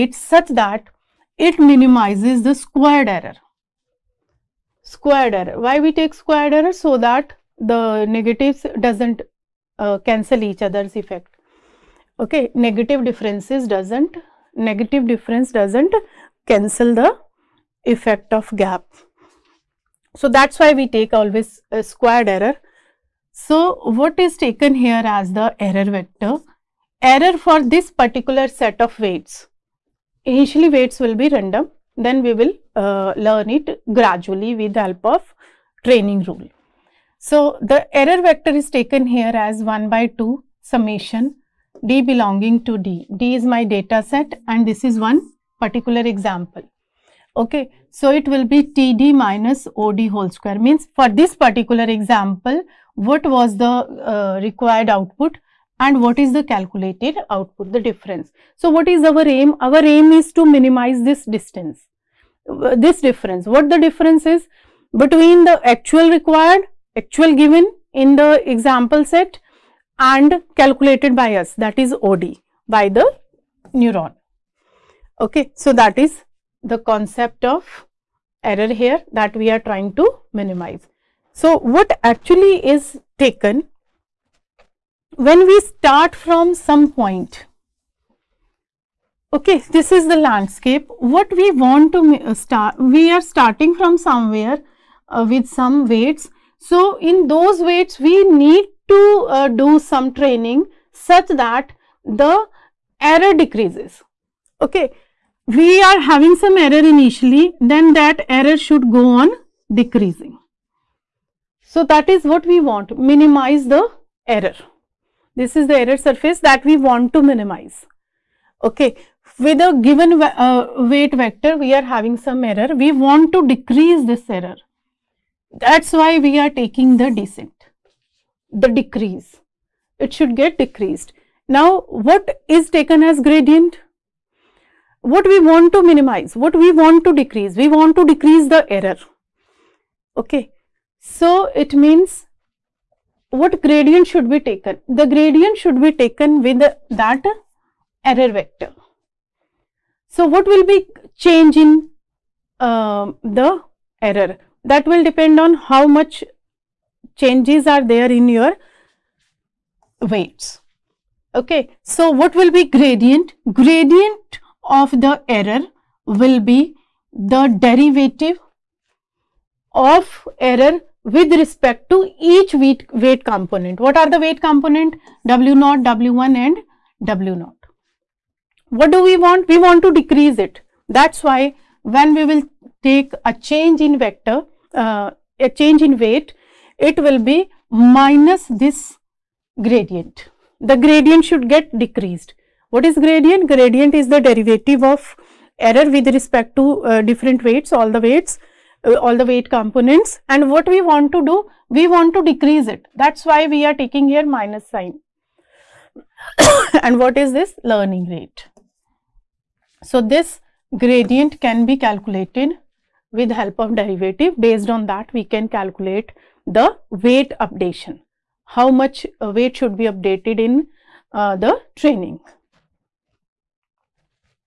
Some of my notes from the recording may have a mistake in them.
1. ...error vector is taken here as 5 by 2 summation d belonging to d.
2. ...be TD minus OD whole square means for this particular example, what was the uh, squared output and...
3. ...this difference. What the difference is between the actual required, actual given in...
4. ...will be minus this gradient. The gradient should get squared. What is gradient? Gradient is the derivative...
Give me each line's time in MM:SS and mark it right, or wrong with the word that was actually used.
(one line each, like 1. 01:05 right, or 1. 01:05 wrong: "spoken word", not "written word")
1. 00:37 wrong: "1", not "5"
2. 00:48 wrong: "required", not "squared"
3. 01:02 right
4. 03:07 wrong: "decreased", not "squared".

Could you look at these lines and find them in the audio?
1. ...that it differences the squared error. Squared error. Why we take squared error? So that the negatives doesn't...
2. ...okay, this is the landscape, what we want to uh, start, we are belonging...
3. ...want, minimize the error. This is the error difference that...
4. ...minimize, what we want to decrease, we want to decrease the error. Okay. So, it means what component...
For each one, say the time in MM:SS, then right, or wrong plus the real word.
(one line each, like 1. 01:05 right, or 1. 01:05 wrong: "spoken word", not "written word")
1. 00:00 wrong: "minimizes", not "differences"
2. 01:29 wrong: "starting", not "belonging"
3. 01:52 wrong: "surface", not "difference"
4. 02:15 wrong: "gradient", not "component".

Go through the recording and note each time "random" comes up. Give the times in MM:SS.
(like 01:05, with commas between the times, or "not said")
00:31.